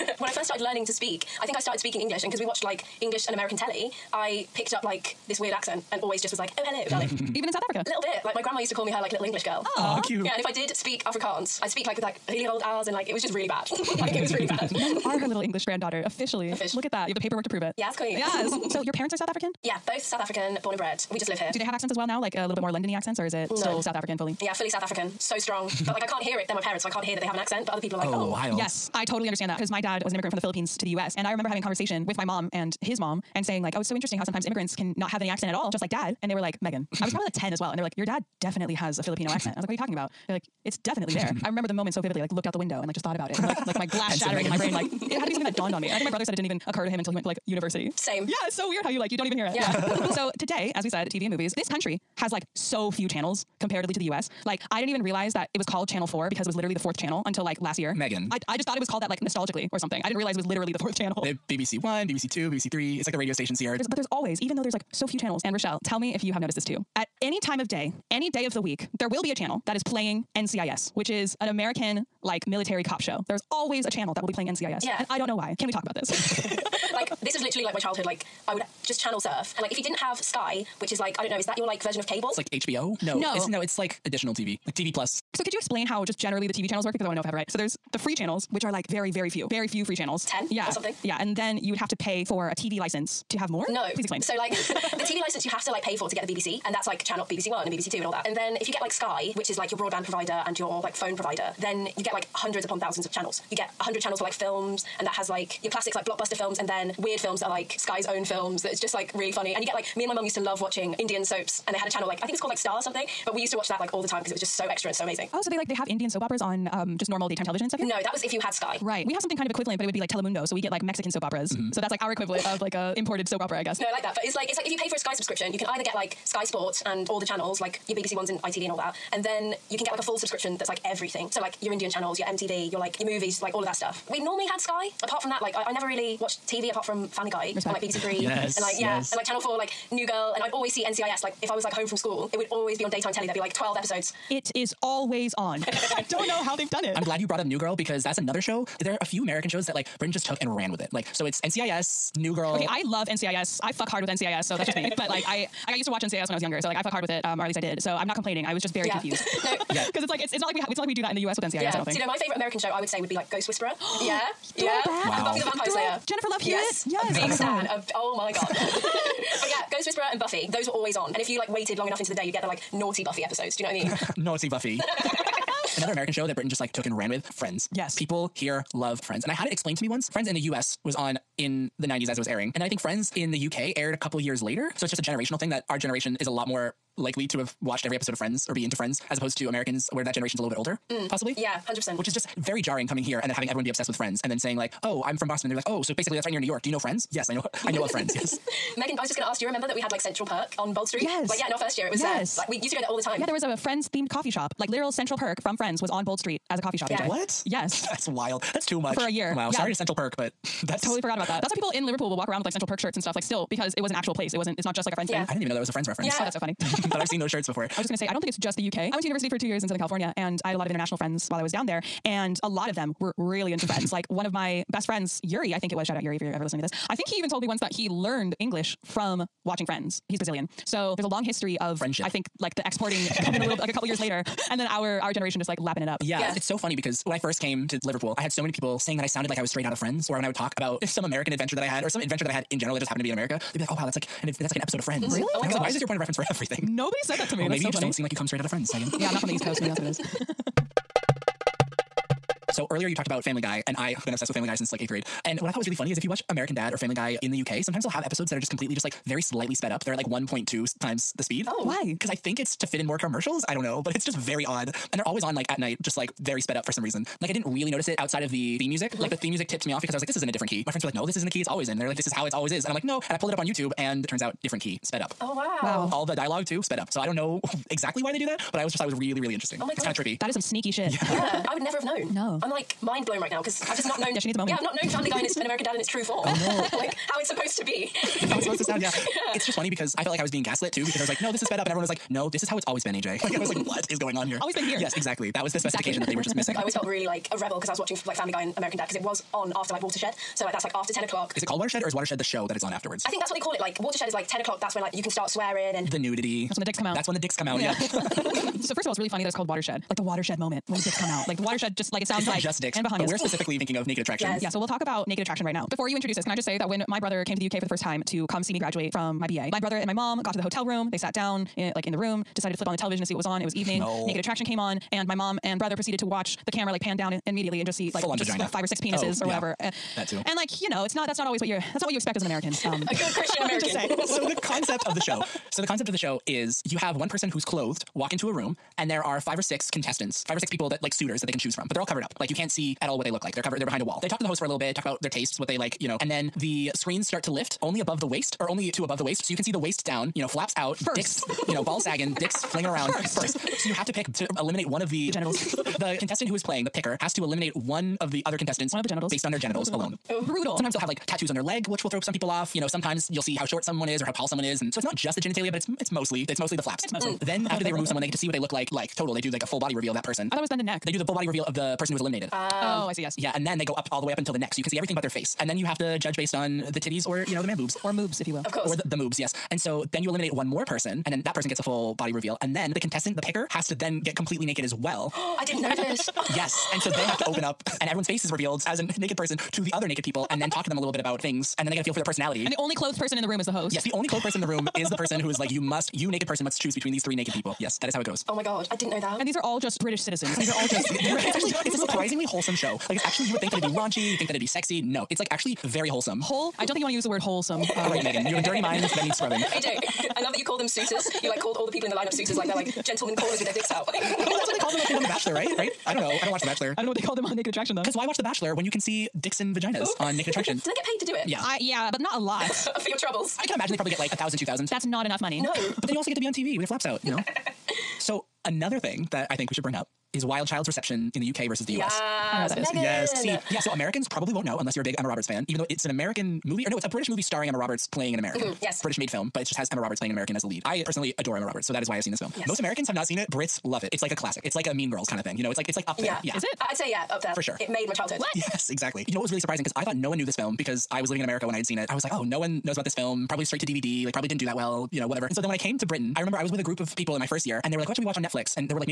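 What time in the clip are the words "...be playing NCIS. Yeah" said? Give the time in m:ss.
1:14.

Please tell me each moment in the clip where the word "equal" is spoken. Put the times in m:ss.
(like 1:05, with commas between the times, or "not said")
not said.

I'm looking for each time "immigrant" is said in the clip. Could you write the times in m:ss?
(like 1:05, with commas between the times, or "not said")
0:30, 0:34.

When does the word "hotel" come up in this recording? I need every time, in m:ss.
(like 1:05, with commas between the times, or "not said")
5:20.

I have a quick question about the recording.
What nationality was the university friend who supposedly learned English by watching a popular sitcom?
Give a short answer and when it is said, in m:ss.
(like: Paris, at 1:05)
Brazilian, at 3:50.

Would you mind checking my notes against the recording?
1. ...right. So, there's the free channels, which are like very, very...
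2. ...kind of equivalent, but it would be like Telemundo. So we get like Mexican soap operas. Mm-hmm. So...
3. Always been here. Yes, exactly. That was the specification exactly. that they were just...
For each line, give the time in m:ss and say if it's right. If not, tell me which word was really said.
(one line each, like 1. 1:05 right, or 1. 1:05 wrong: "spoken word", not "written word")
1. 1:27 right
2. 1:59 right
3. 4:54 right.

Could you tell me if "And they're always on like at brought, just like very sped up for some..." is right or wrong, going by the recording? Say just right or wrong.
wrong.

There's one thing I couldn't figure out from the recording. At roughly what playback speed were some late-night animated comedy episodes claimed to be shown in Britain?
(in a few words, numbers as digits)
1.2 times.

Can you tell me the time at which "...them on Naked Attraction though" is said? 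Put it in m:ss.
6:57.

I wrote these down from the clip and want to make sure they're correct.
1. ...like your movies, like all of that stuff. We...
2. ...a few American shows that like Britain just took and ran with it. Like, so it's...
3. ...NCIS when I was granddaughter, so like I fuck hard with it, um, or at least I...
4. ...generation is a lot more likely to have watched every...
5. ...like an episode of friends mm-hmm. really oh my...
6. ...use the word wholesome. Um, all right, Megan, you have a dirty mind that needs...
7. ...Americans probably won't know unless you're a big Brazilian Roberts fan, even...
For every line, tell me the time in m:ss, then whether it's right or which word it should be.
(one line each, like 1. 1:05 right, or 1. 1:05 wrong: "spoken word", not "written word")
1. 2:12 right
2. 2:29 right
3. 2:36 wrong: "younger", not "granddaughter"
4. 3:05 right
5. 4:04 right
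6. 6:46 right
7. 7:13 wrong: "Emma", not "Brazilian".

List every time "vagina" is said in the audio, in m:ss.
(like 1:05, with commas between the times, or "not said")
5:28, 6:59.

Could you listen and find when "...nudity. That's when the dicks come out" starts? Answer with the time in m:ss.
5:05.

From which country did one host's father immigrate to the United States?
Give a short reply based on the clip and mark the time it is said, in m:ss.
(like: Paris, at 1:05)
the Philippines, at 0:30.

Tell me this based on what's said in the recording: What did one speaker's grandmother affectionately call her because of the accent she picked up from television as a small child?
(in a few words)
little English girl.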